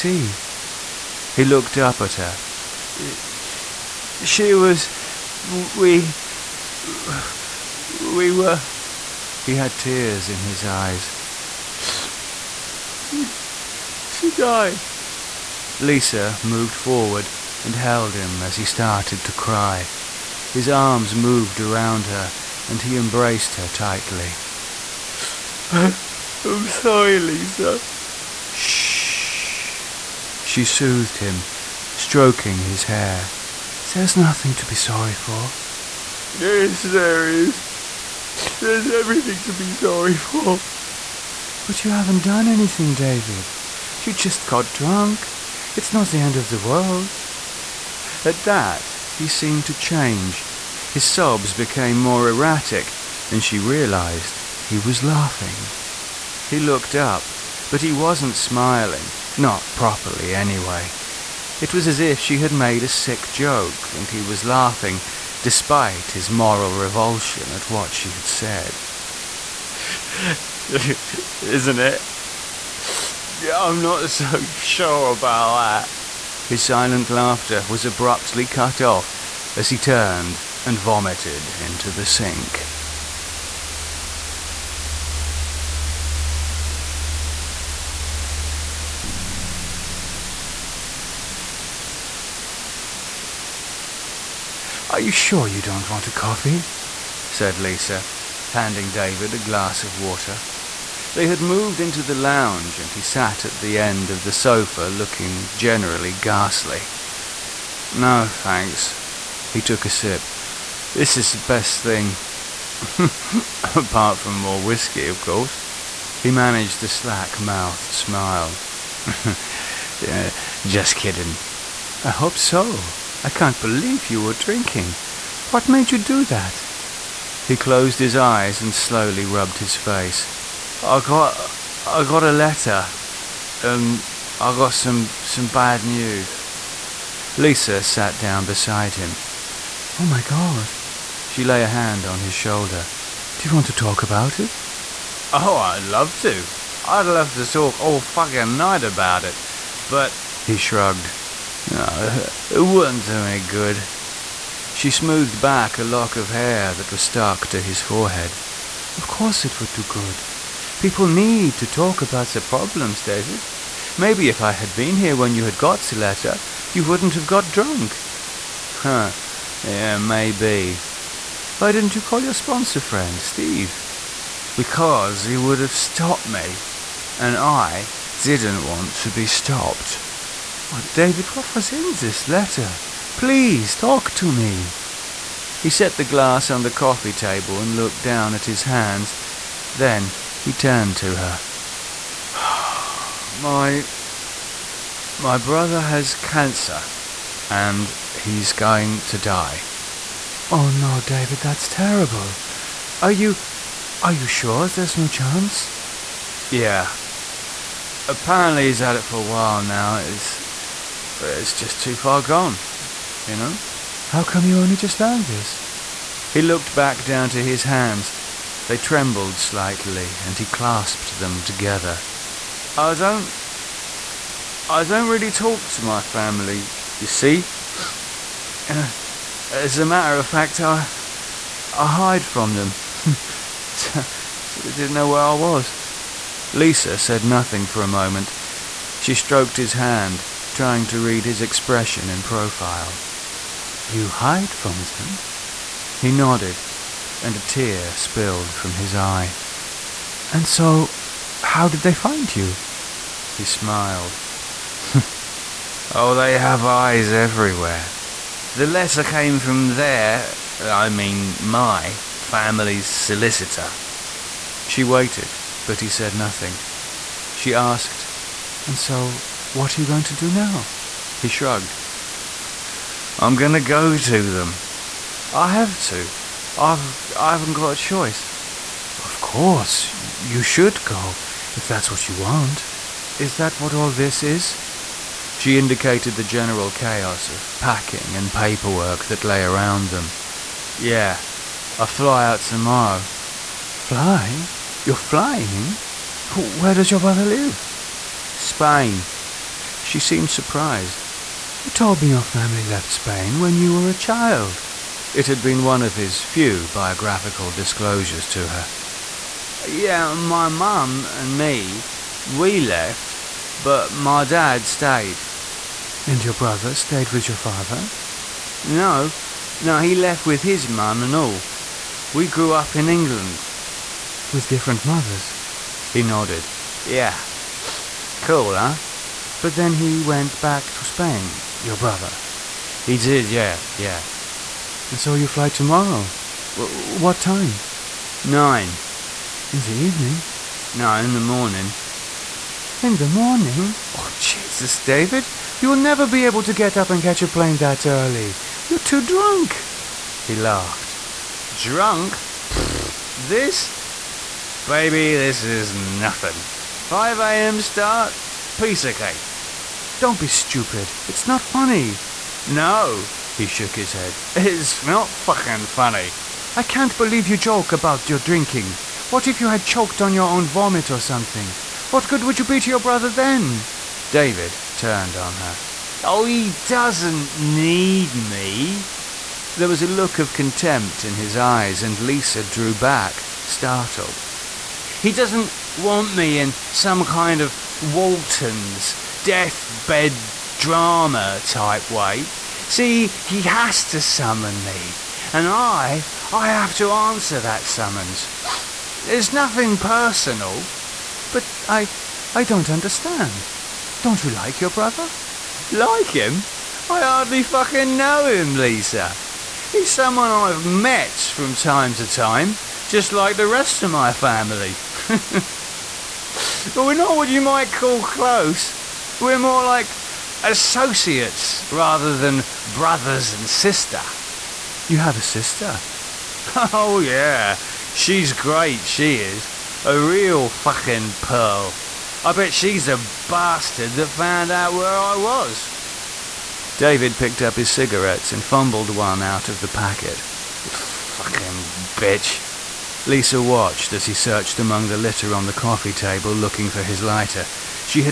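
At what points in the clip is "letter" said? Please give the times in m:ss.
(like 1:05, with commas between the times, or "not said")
2:12, 2:45, 3:02, 4:18.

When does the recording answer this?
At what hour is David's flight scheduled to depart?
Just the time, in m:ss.
5:38.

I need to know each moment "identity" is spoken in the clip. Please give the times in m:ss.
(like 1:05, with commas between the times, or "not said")
not said.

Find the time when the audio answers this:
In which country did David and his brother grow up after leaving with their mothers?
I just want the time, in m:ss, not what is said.
5:22.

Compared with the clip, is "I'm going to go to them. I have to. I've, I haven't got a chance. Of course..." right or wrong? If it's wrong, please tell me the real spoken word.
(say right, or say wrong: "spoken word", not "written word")
wrong: "choice", not "chance".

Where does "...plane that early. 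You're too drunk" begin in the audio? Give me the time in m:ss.
5:47.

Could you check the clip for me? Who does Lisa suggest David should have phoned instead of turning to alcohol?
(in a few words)
Steve.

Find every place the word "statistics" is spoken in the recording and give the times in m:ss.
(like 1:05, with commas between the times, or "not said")
not said.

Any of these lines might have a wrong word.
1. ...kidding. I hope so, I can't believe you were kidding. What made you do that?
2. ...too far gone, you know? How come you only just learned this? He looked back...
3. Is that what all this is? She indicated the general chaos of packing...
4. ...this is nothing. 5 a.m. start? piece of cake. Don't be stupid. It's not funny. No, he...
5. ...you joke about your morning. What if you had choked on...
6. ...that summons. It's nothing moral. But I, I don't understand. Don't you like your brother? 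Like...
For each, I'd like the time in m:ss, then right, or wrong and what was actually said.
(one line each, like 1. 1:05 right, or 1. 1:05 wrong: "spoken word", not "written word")
1. 2:00 wrong: "drinking", not "kidding"
2. 3:31 right
3. 4:43 right
4. 5:55 right
5. 6:07 wrong: "drinking", not "morning"
6. 6:37 wrong: "personal", not "moral".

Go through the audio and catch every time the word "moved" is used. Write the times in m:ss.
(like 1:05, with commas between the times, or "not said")
0:16, 0:21, 1:41.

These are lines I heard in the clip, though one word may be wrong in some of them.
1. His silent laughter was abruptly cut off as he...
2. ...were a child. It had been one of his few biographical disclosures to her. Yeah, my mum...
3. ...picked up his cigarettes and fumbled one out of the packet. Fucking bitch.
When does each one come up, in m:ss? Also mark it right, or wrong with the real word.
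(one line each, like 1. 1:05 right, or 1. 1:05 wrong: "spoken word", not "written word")
1. 1:16 right
2. 5:03 right
3. 7:17 right.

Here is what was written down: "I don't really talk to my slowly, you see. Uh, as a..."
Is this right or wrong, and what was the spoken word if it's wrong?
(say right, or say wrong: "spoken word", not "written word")
wrong: "family", not "slowly".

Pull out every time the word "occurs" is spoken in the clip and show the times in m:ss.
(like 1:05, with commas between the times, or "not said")
not said.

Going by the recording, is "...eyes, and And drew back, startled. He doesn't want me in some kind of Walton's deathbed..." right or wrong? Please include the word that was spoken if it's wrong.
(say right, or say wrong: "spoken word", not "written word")
wrong: "Lisa", not "And".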